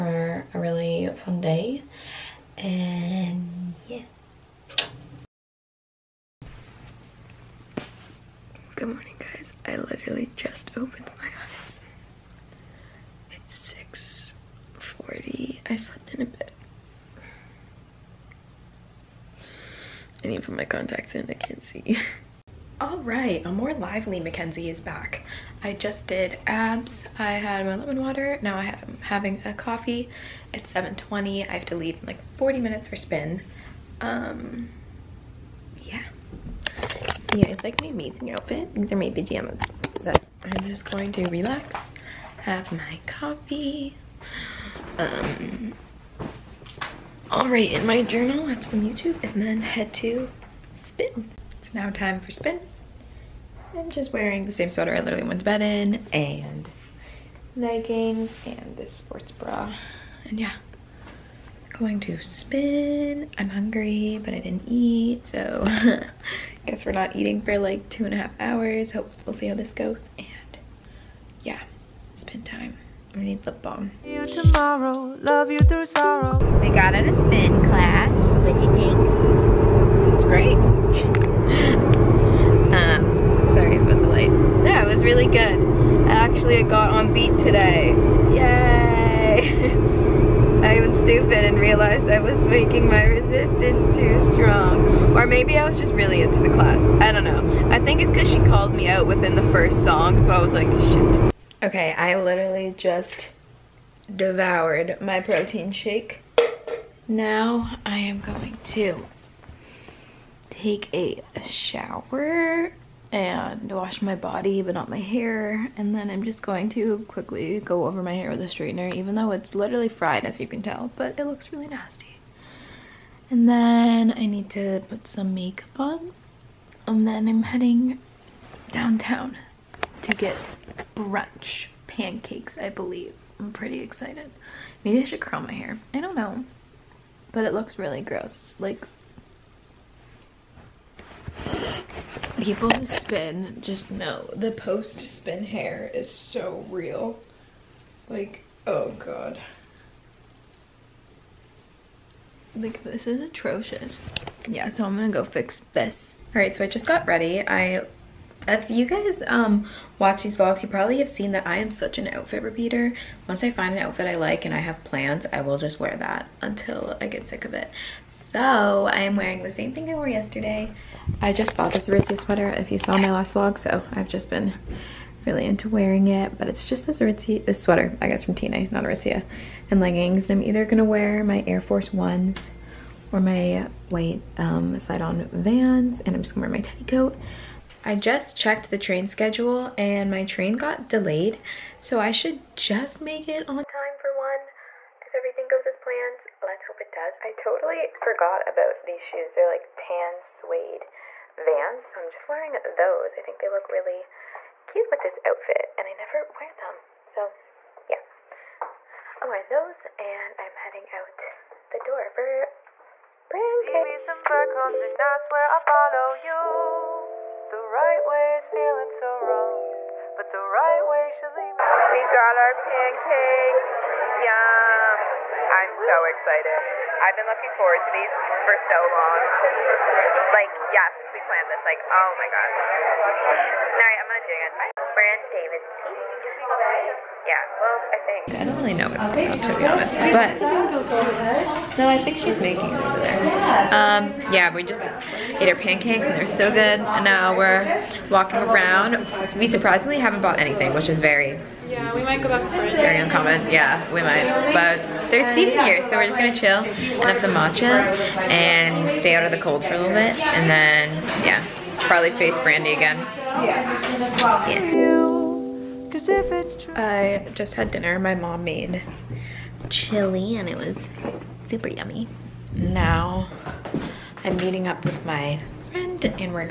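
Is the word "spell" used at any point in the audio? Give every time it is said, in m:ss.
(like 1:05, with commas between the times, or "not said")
not said.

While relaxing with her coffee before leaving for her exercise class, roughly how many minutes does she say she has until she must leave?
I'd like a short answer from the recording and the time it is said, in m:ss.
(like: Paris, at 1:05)
40, at 0:32.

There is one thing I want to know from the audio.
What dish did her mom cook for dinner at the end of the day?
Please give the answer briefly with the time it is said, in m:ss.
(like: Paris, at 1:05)
chili, at 4:29.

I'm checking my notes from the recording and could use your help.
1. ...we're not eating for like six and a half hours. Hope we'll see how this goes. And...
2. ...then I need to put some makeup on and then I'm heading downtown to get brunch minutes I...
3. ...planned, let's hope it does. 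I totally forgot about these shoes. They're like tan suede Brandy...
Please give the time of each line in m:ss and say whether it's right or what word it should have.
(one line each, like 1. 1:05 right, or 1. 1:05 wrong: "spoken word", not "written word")
1. 1:06 wrong: "two", not "six"
2. 2:03 wrong: "pancakes", not "minutes"
3. 3:15 wrong: "Vans", not "Brandy".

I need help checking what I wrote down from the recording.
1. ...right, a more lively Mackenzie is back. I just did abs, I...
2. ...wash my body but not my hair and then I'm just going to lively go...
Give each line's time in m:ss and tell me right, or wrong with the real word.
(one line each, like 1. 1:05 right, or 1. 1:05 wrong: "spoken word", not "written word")
1. 0:22 right
2. 1:53 wrong: "quickly", not "lively".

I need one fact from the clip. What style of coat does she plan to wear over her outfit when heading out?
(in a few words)
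teddy coat.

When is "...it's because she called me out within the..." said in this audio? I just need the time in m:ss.
1:38.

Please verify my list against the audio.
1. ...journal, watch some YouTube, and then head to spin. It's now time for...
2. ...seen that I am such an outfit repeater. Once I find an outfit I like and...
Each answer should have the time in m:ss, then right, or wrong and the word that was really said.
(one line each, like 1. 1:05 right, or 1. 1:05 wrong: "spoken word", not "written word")
1. 0:48 right
2. 2:41 right.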